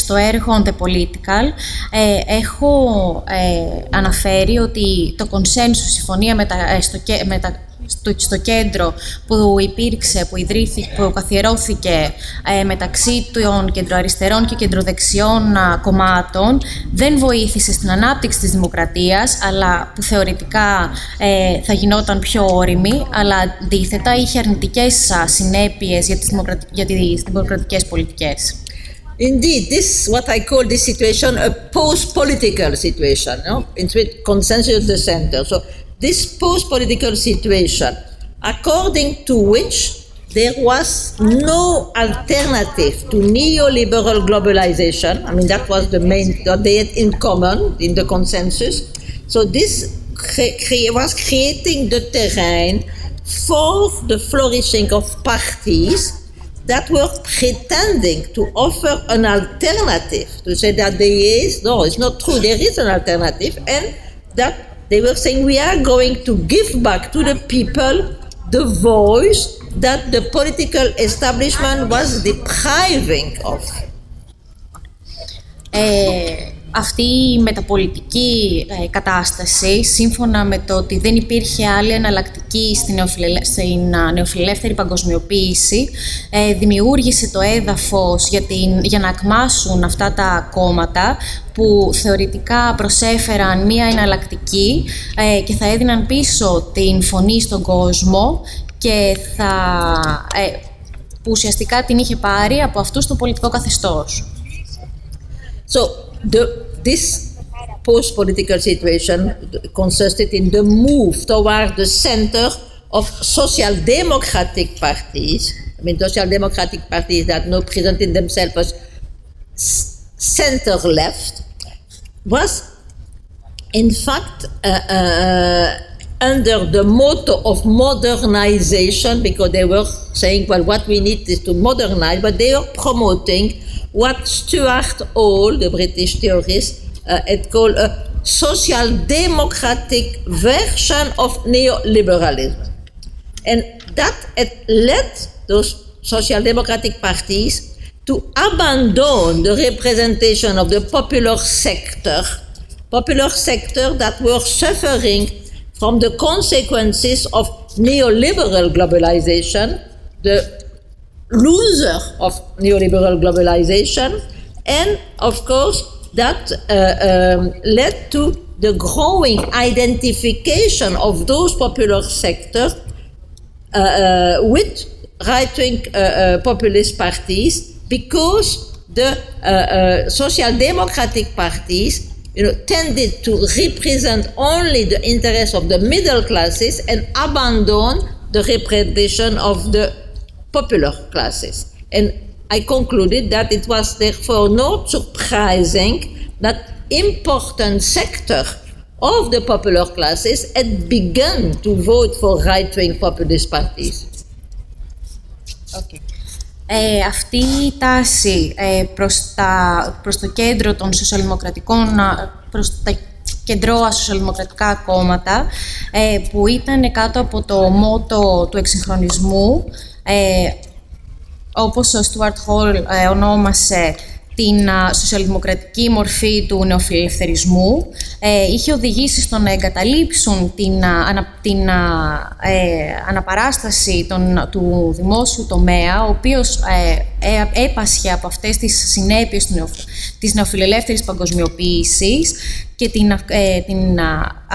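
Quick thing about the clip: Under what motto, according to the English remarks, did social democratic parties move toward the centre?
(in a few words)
modernization.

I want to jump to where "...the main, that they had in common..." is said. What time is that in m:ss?
0:45.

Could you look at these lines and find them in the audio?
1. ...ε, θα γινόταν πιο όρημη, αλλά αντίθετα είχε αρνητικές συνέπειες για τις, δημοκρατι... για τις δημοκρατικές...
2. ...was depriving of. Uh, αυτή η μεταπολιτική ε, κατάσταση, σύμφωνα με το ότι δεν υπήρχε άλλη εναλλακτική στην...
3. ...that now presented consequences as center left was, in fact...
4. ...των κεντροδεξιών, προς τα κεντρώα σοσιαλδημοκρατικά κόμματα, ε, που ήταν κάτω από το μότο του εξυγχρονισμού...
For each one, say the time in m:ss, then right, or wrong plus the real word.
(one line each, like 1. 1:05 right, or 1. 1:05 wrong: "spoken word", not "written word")
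1. 0:21 right
2. 1:11 right
3. 1:57 wrong: "themselves", not "consequences"
4. 3:30 wrong: "σοσιαλδημοκρατικών", not "κεντροδεξιών".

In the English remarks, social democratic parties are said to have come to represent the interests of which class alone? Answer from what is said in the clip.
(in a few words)
middle classes.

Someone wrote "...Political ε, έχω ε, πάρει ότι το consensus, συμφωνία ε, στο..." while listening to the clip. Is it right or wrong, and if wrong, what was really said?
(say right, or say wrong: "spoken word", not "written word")
wrong: "αναφέρει", not "πάρει".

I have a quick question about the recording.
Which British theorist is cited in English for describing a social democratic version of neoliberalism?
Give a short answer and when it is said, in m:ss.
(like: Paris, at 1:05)
Stuart Hall, at 2:14.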